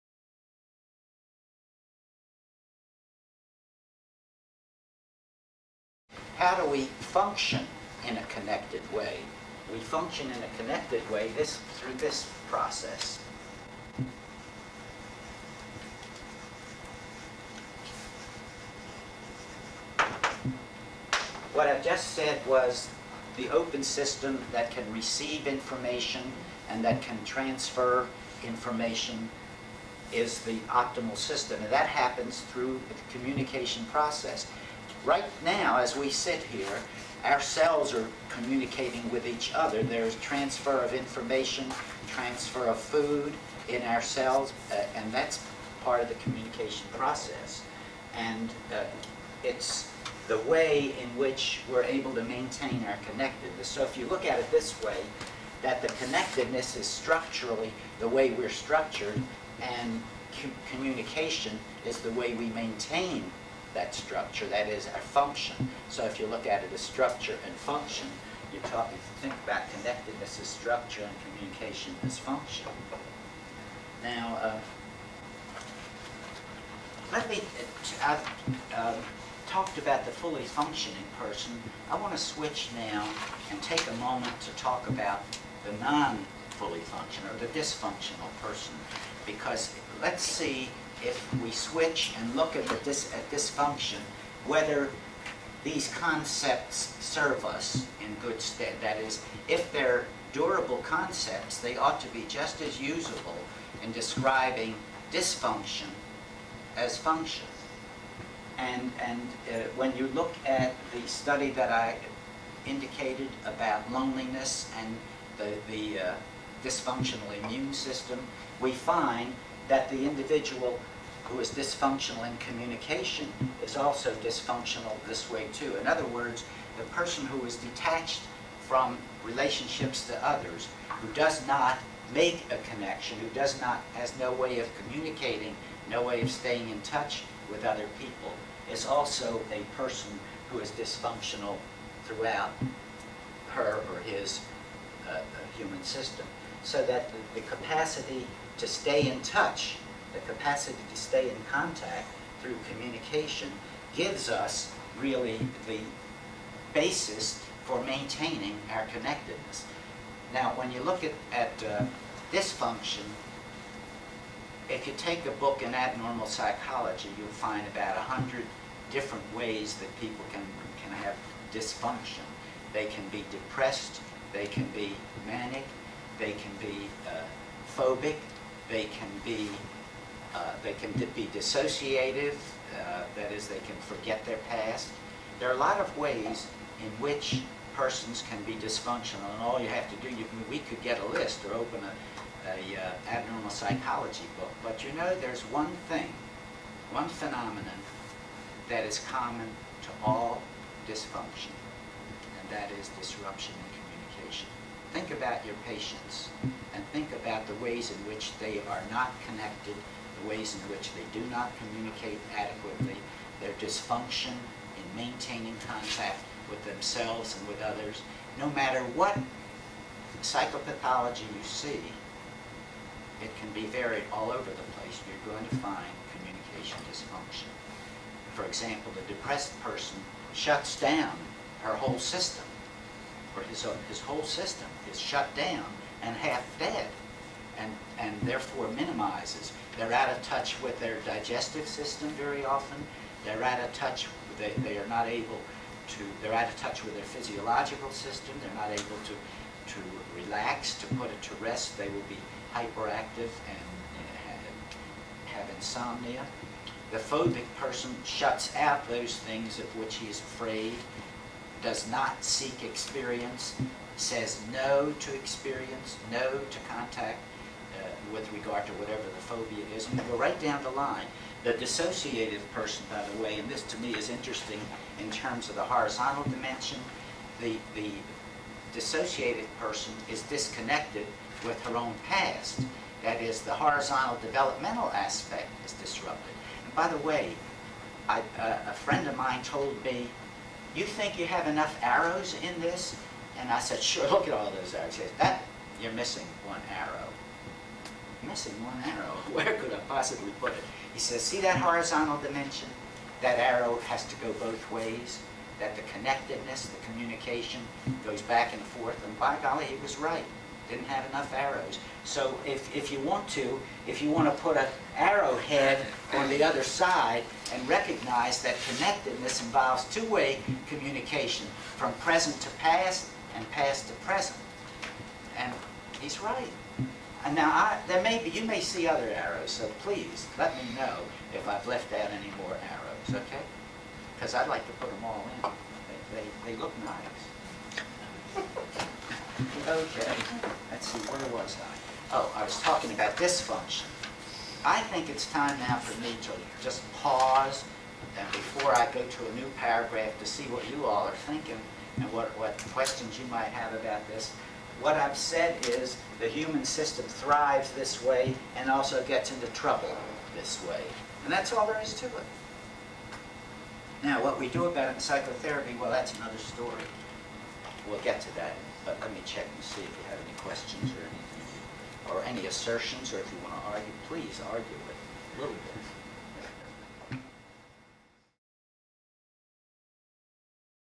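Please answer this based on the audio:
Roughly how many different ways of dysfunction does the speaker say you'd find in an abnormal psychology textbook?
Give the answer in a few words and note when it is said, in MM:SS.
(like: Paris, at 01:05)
100, at 02:47.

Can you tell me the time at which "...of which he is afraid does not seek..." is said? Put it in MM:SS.
04:19.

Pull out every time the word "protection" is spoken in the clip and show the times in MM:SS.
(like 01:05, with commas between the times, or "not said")
not said.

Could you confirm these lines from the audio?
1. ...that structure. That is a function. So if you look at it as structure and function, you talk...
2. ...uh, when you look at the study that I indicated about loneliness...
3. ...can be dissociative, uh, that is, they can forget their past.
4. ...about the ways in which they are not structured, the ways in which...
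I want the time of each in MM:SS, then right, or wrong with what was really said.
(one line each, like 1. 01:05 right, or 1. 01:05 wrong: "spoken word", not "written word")
1. 01:03 right
2. 01:49 right
3. 03:00 right
4. 03:27 wrong: "connected", not "structured".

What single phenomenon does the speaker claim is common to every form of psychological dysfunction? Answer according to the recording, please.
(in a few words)
Disruption in communication.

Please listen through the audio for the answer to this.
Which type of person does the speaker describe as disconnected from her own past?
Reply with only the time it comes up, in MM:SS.
04:38.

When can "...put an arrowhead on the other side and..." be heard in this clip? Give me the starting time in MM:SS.
05:14.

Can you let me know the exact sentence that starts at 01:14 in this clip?
Now, uh, let me, uh, I've uh, talked about the fully functioning person.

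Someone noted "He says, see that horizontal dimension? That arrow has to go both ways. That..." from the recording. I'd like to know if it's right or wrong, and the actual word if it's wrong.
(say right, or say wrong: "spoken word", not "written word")
right.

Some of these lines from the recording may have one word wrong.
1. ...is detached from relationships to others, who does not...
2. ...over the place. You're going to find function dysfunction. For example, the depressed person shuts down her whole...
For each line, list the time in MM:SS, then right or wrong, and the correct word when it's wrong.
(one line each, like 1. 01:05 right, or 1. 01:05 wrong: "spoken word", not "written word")
1. 02:07 right
2. 03:44 wrong: "communication", not "function".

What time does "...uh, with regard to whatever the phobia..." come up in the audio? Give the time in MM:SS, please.
04:27.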